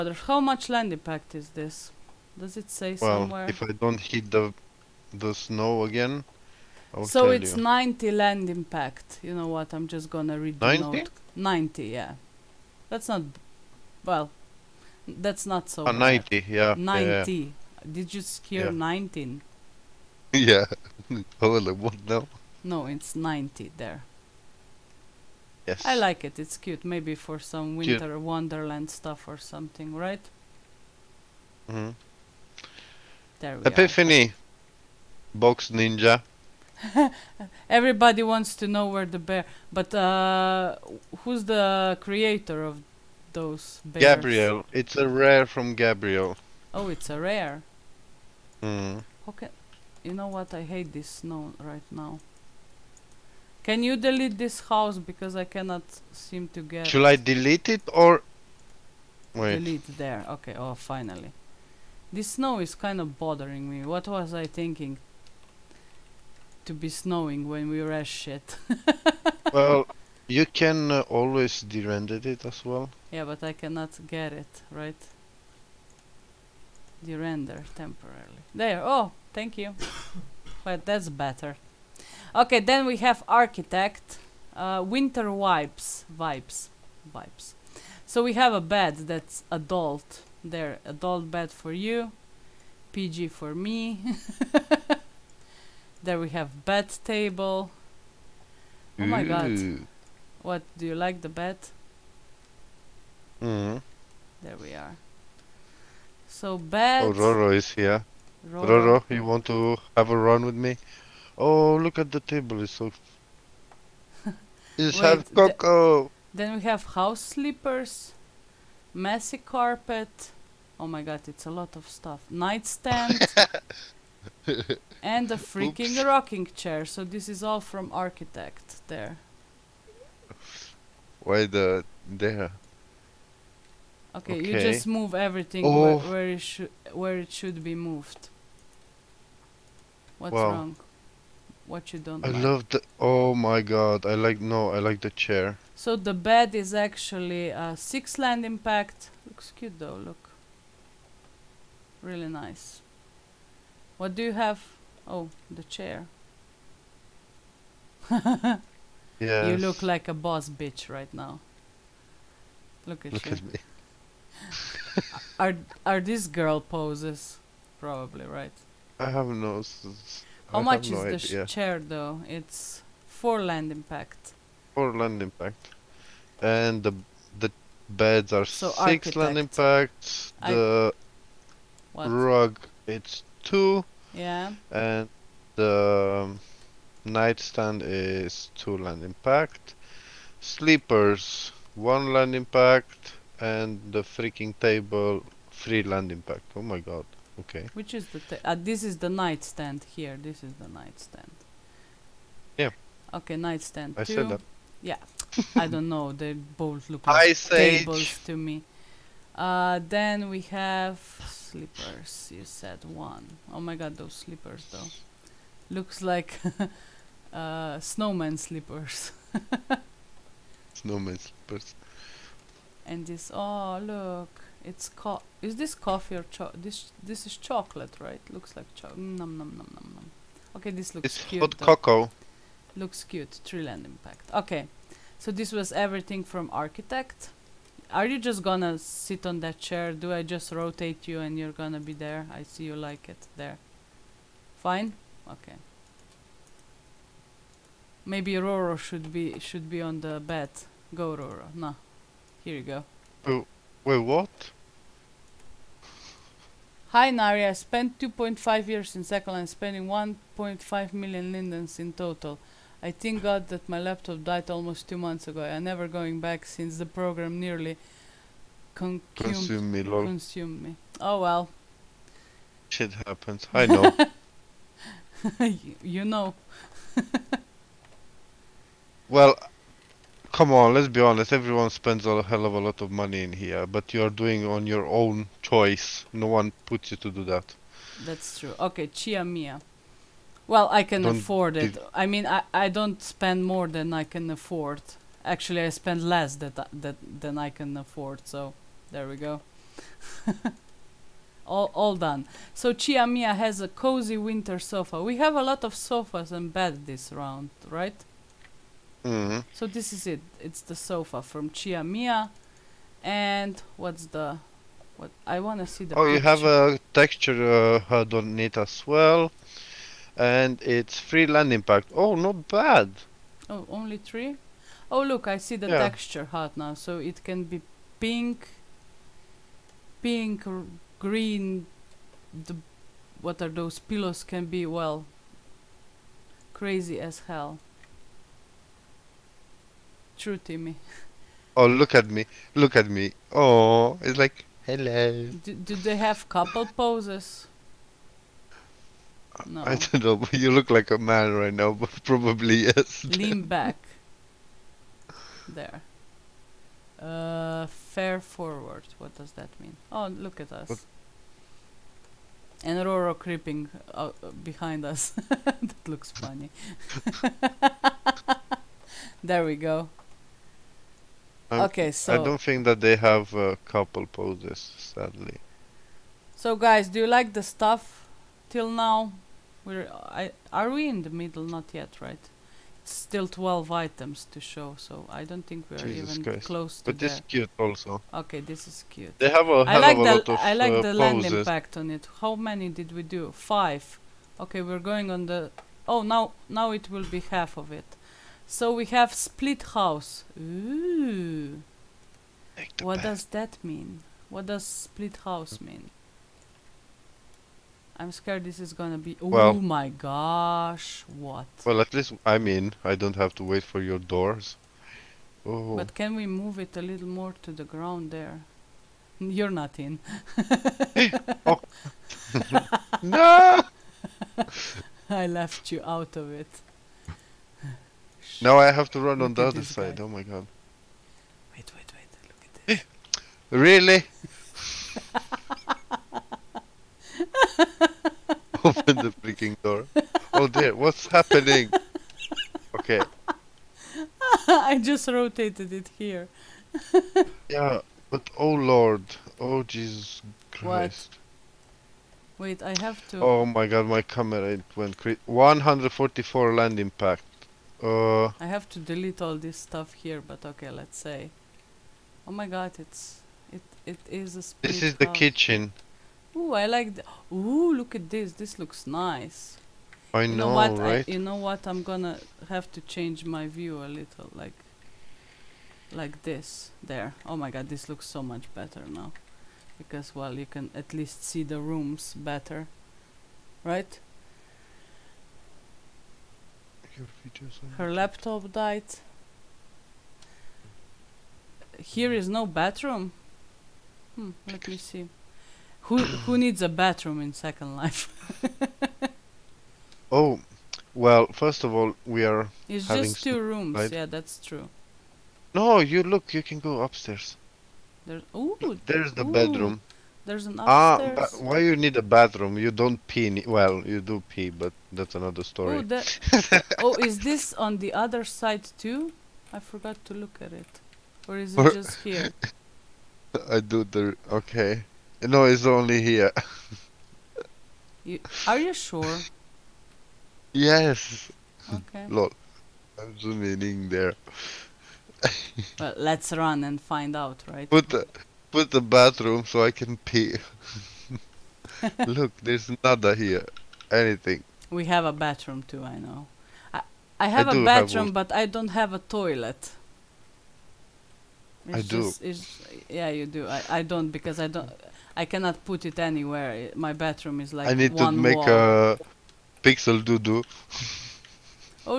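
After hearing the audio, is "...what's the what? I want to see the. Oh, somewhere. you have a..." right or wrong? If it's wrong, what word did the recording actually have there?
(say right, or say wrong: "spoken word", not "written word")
wrong: "picture", not "somewhere".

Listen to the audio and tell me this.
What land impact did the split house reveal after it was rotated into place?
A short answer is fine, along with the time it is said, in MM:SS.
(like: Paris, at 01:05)
144, at 07:35.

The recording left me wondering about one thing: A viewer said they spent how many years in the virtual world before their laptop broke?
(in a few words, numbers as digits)
2.5 years.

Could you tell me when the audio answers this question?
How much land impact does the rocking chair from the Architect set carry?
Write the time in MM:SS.
02:52.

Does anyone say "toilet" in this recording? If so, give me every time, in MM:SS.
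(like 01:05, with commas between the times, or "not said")
09:08.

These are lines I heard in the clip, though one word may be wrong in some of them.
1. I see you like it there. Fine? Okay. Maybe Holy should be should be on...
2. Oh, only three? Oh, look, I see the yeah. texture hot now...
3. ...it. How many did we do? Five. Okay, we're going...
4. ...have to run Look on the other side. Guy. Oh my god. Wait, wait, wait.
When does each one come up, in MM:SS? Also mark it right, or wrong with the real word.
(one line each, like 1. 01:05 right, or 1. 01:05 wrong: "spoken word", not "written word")
1. 04:02 wrong: "Roro", not "Holy"
2. 05:23 right
3. 06:31 right
4. 07:08 right.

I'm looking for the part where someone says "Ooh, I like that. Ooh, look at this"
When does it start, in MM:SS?
07:46.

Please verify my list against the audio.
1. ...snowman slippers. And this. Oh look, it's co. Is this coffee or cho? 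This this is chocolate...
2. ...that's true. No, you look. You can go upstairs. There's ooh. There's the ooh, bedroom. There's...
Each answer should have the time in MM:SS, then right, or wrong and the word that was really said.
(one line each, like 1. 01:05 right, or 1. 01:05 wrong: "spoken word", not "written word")
1. 03:40 right
2. 08:24 right.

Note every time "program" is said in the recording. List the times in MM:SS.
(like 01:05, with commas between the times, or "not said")
04:26.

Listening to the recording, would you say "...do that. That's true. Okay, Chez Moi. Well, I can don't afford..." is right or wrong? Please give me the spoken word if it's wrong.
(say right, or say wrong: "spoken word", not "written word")
right.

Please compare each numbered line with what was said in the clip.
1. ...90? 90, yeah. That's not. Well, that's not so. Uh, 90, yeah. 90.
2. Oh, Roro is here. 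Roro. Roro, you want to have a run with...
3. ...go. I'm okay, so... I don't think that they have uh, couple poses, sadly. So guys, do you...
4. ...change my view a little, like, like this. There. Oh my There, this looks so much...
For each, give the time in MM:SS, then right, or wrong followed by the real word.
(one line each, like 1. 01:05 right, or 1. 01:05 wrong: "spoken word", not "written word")
1. 00:10 right
2. 01:47 right
3. 06:09 right
4. 07:52 wrong: "God", not "There".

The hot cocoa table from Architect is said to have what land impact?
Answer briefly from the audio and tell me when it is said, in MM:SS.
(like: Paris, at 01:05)
3, at 03:15.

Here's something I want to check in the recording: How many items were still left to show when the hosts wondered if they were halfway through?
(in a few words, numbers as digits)
12.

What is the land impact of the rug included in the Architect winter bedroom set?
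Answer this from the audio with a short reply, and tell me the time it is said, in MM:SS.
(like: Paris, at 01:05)
2, at 03:02.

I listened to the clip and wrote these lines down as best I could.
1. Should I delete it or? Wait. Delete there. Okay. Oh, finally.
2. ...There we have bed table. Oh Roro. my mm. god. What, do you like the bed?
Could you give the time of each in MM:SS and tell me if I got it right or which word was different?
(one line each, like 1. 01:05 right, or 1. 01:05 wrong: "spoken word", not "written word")
1. 00:56 right
2. 01:36 wrong: "Ooh", not "Roro".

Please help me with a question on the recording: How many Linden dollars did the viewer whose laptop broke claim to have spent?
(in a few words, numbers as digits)
1.5 million lindens.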